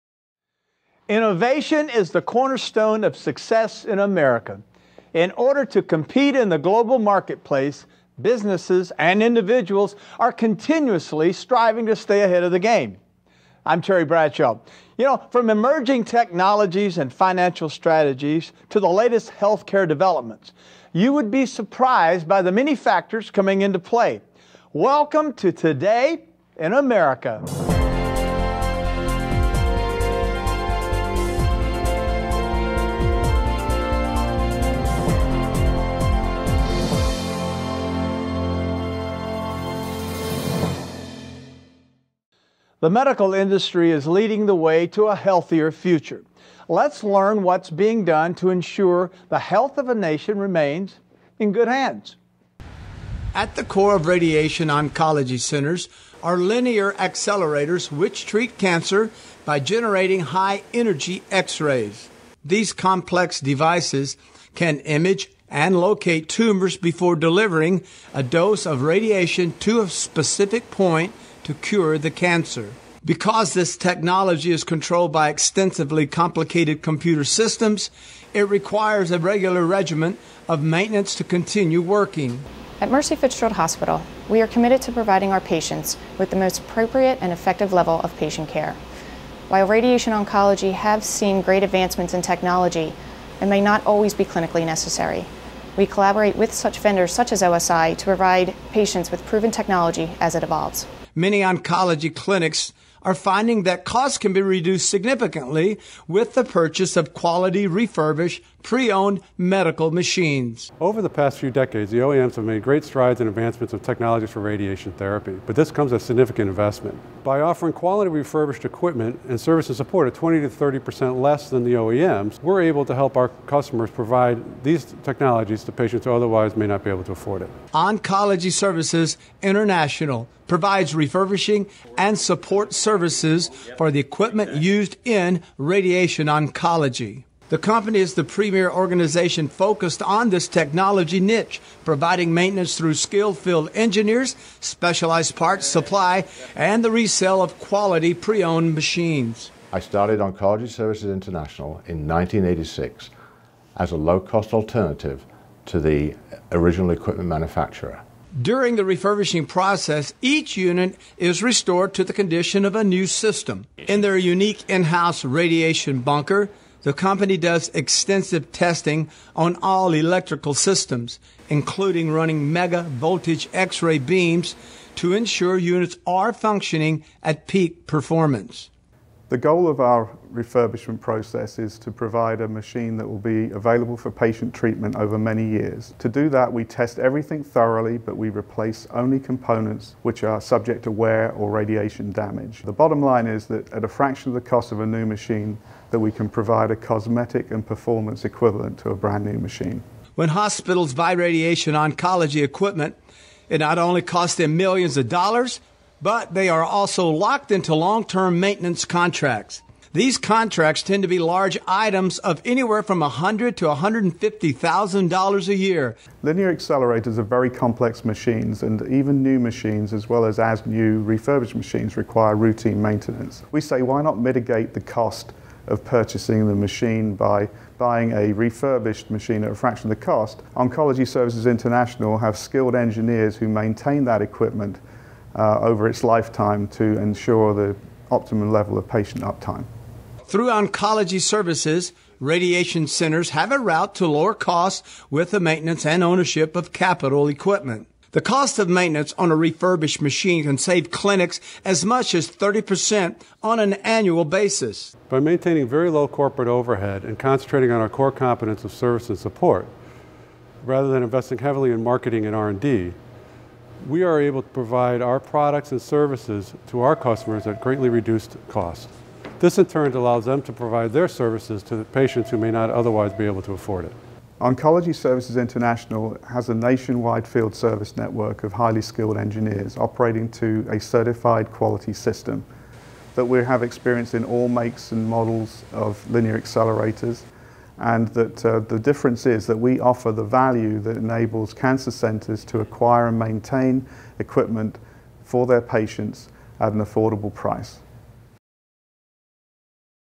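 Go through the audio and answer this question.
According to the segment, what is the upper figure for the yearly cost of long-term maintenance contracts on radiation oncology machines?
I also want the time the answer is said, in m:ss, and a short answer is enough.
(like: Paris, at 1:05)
$150,000, at 3:33.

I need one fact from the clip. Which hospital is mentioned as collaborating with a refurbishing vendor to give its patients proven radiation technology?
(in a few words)
Mercy Fitzgerald Hospital.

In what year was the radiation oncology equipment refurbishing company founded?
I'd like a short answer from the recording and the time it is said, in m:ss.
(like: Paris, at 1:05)
1986, at 2:32.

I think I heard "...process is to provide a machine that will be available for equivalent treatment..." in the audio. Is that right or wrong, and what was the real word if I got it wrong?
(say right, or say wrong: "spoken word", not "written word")
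wrong: "patient", not "equivalent".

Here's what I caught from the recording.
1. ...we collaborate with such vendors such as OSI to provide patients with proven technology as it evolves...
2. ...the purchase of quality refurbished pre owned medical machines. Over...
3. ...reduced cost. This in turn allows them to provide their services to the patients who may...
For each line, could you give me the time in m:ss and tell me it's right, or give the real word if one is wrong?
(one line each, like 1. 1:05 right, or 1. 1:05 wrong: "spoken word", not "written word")
1. 1:35 right
2. 1:46 right
3. 4:27 right.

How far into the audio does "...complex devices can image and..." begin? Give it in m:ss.
1:02.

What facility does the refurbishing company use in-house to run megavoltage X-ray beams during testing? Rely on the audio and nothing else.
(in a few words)
radiation bunker.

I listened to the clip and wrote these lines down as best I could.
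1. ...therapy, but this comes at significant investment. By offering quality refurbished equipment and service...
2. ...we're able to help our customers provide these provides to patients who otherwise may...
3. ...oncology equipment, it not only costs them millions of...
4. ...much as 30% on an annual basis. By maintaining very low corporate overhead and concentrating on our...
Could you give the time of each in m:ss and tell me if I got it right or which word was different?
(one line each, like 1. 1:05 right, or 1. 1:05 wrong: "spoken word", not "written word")
1. 1:54 right
2. 2:02 wrong: "technologies", not "provides"
3. 3:21 right
4. 4:11 right.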